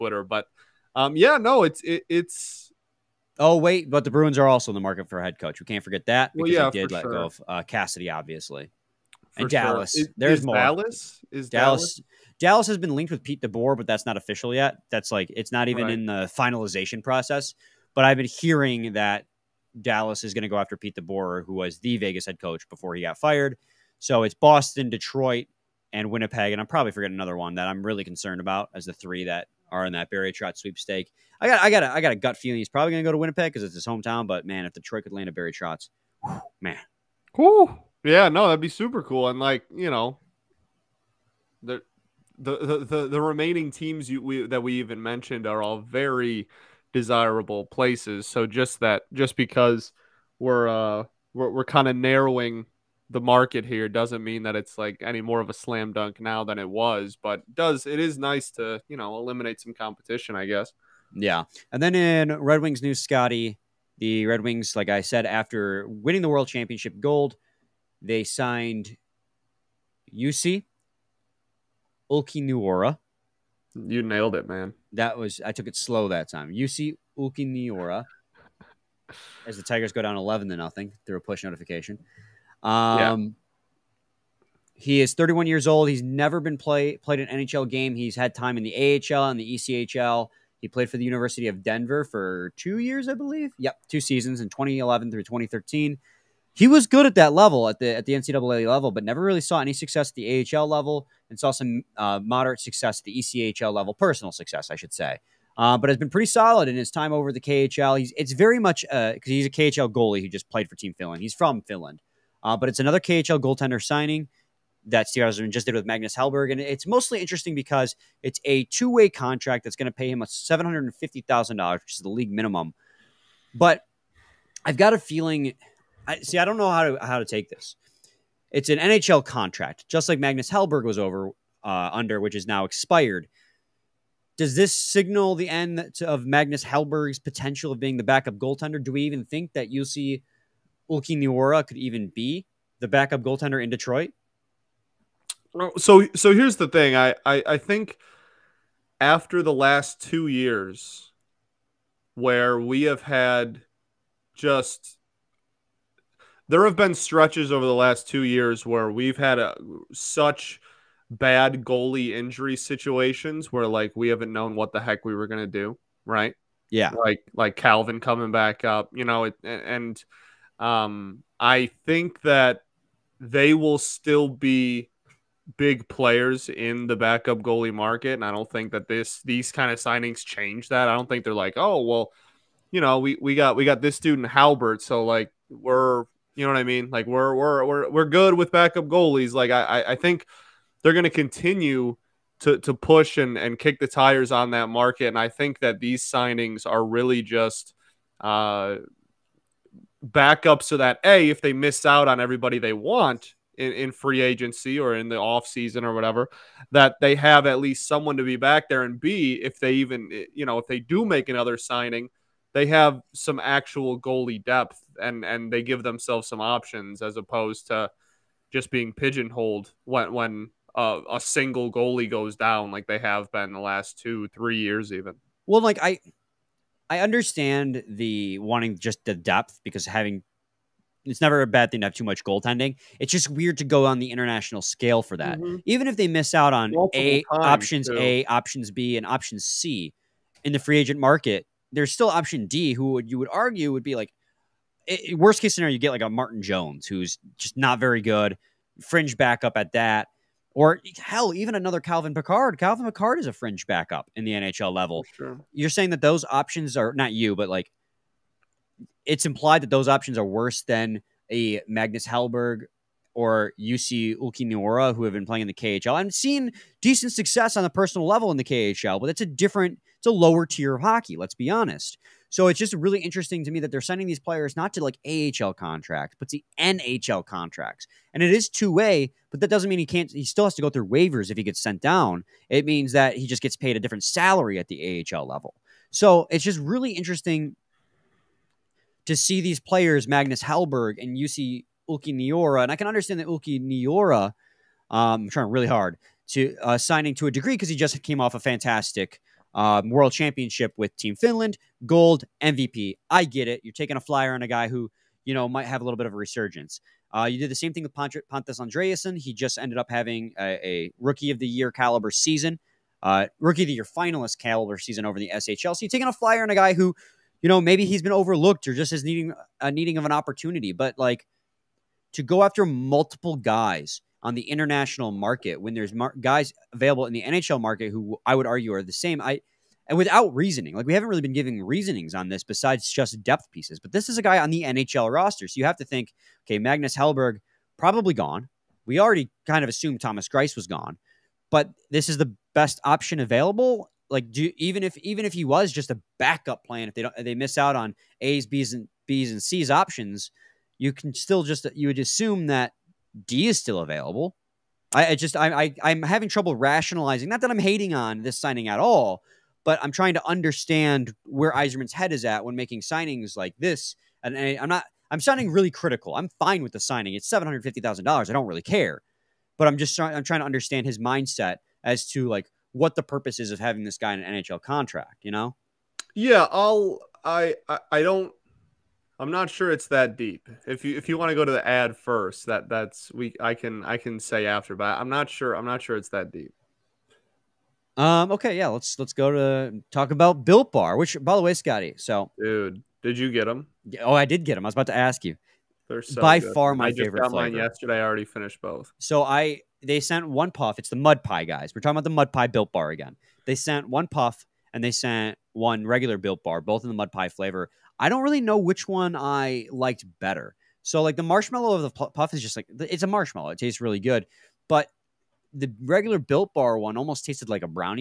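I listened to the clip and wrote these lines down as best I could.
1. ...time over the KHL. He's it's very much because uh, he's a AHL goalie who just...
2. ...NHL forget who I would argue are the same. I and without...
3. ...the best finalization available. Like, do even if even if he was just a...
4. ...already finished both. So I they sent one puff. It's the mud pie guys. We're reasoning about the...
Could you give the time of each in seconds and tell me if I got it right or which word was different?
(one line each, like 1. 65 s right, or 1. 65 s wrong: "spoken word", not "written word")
1. 106 s wrong: "KHL", not "AHL"
2. 327 s wrong: "market", not "forget"
3. 342 s wrong: "option", not "finalization"
4. 398 s wrong: "talking", not "reasoning".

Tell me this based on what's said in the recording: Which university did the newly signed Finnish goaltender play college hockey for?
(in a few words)
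University of Denver.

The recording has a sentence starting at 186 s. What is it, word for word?
Like we're we're we're we're good with backup goalies.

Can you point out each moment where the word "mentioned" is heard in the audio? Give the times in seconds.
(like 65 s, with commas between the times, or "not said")
45 s.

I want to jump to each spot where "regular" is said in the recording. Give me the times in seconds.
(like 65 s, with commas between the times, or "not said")
405 s, 415 s.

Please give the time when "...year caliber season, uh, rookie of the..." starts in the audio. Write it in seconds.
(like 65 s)
311 s.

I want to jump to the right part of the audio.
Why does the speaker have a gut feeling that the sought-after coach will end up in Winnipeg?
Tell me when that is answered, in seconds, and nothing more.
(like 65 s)
33 s.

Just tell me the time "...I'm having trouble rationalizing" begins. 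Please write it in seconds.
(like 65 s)
355 s.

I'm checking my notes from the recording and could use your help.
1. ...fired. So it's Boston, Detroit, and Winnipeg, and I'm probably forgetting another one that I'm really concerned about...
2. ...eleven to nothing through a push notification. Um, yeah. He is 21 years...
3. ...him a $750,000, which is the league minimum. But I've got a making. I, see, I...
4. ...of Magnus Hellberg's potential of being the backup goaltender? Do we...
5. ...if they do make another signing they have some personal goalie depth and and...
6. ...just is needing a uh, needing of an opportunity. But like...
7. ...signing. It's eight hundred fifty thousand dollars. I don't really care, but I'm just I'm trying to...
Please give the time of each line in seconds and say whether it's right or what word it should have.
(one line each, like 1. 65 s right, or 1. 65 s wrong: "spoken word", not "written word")
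1. 23 s right
2. 80 s wrong: "31", not "21"
3. 120 s wrong: "feeling", not "making"
4. 136 s right
5. 210 s wrong: "actual", not "personal"
6. 318 s right
7. 366 s wrong: "seven", not "eight".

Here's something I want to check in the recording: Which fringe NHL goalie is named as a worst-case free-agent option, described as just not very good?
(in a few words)
Martin Jones.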